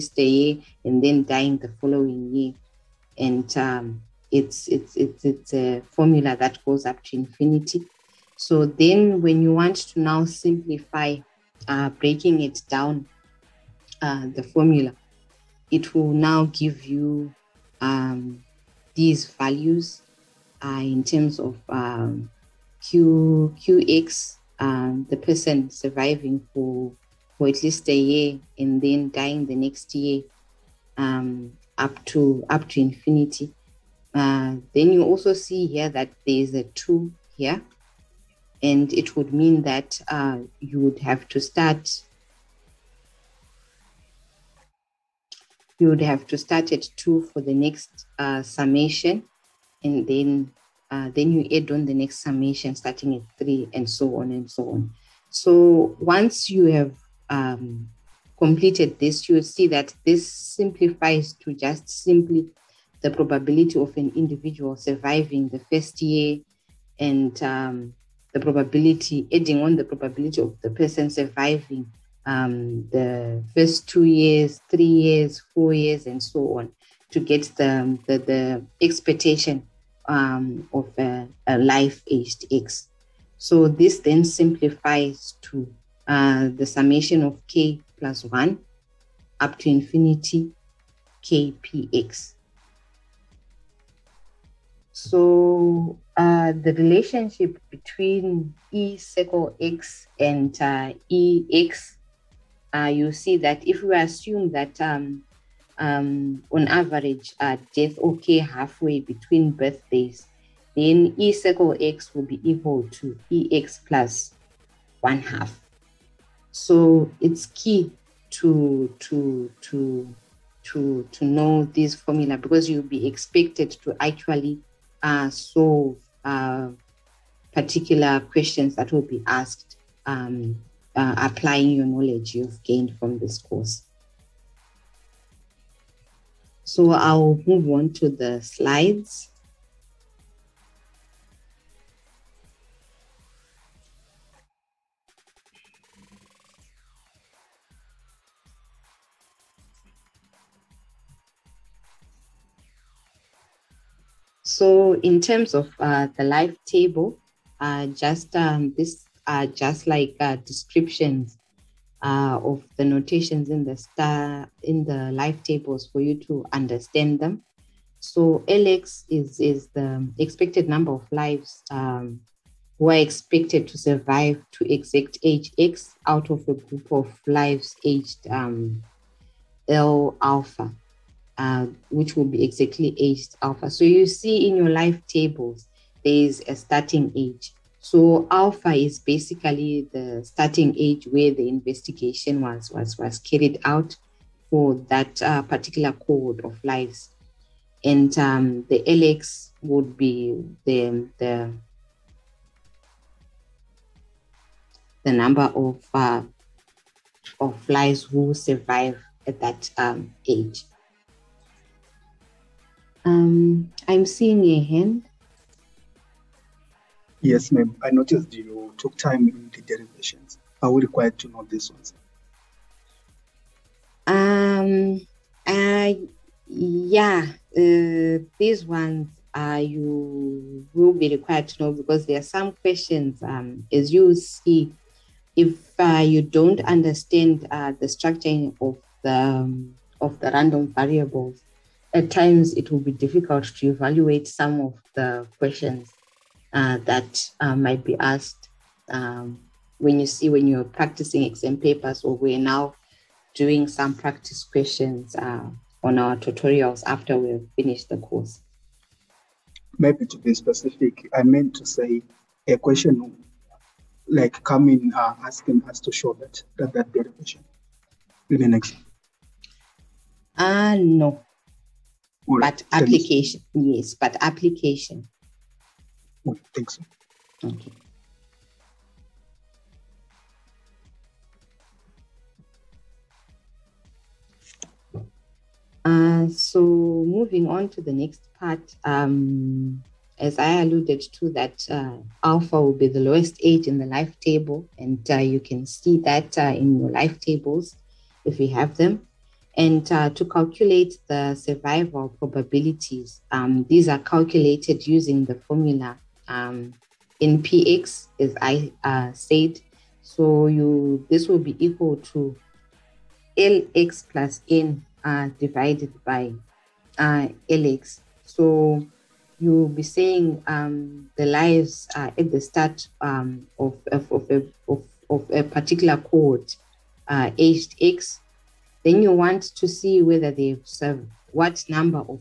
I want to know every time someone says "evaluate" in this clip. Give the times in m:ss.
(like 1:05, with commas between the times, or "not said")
4:03.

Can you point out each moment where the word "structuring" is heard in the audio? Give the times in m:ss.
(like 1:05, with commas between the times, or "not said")
3:57.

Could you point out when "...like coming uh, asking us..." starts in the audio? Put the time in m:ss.
4:24.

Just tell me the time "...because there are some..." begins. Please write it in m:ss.
3:51.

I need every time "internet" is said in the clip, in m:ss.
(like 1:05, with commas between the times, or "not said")
not said.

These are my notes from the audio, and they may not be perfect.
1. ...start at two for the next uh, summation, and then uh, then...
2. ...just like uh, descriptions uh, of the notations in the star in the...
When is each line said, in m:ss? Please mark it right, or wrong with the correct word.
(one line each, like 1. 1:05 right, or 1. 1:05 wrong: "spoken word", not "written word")
1. 0:46 right
2. 2:39 right.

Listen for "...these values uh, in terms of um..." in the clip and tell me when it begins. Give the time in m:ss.
0:18.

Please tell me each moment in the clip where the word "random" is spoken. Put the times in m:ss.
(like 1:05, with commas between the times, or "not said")
4:00.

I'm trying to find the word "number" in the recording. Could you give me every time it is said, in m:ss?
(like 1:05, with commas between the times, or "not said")
2:50, 3:25, 5:31.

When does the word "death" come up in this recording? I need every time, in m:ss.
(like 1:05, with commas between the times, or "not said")
1:47.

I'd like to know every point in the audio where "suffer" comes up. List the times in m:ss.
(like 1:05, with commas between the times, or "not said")
not said.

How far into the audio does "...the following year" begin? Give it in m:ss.
0:01.